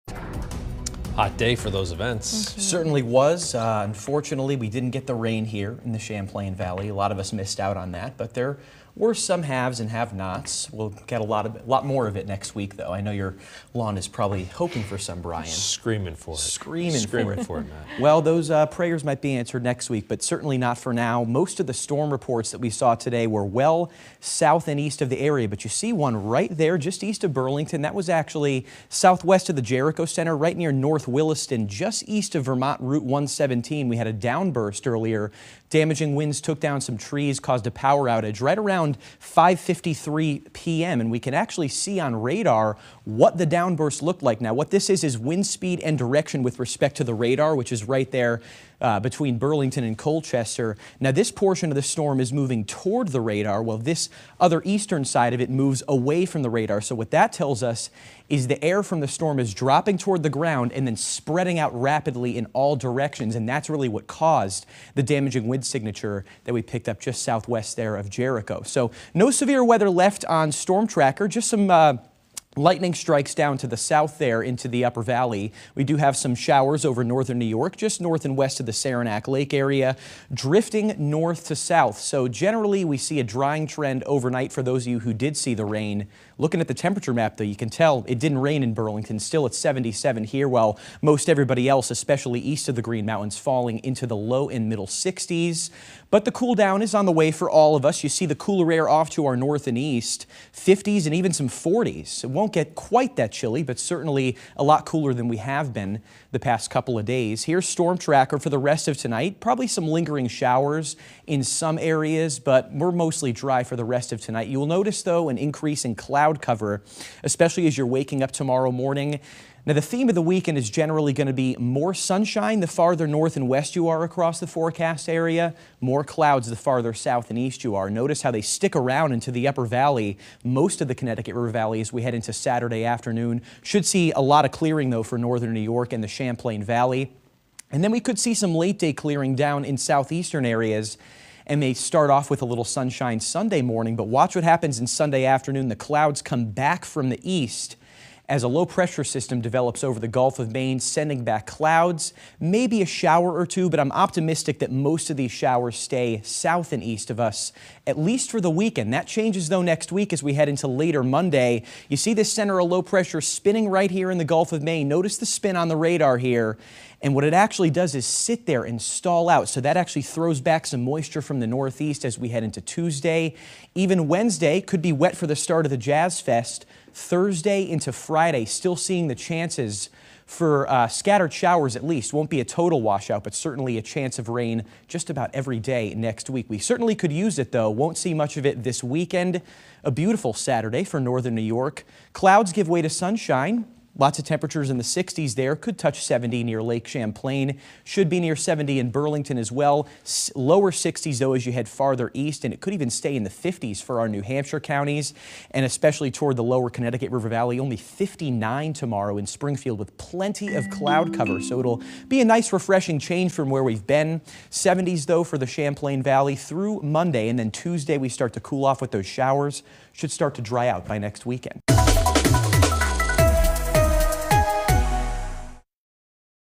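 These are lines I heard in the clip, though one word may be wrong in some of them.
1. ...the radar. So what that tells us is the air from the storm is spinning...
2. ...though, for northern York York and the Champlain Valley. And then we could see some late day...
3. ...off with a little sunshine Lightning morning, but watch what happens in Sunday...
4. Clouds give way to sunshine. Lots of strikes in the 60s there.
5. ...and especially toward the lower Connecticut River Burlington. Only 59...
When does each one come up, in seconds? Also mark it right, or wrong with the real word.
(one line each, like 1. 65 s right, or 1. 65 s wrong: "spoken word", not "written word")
1. 56 s wrong: "dropping", not "spinning"
2. 134 s wrong: "New", not "York"
3. 142 s wrong: "Sunday", not "Lightning"
4. 192 s wrong: "temperatures", not "strikes"
5. 205 s wrong: "Valley", not "Burlington".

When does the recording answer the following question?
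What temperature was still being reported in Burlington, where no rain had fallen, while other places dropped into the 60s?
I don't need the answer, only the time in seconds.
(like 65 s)
89 s.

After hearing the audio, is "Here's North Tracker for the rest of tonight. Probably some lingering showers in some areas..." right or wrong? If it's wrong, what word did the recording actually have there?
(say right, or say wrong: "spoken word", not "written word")
wrong: "Storm", not "North".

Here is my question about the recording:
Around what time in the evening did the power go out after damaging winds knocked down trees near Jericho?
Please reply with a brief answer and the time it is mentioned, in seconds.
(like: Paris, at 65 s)
5:53 p.m., at 39 s.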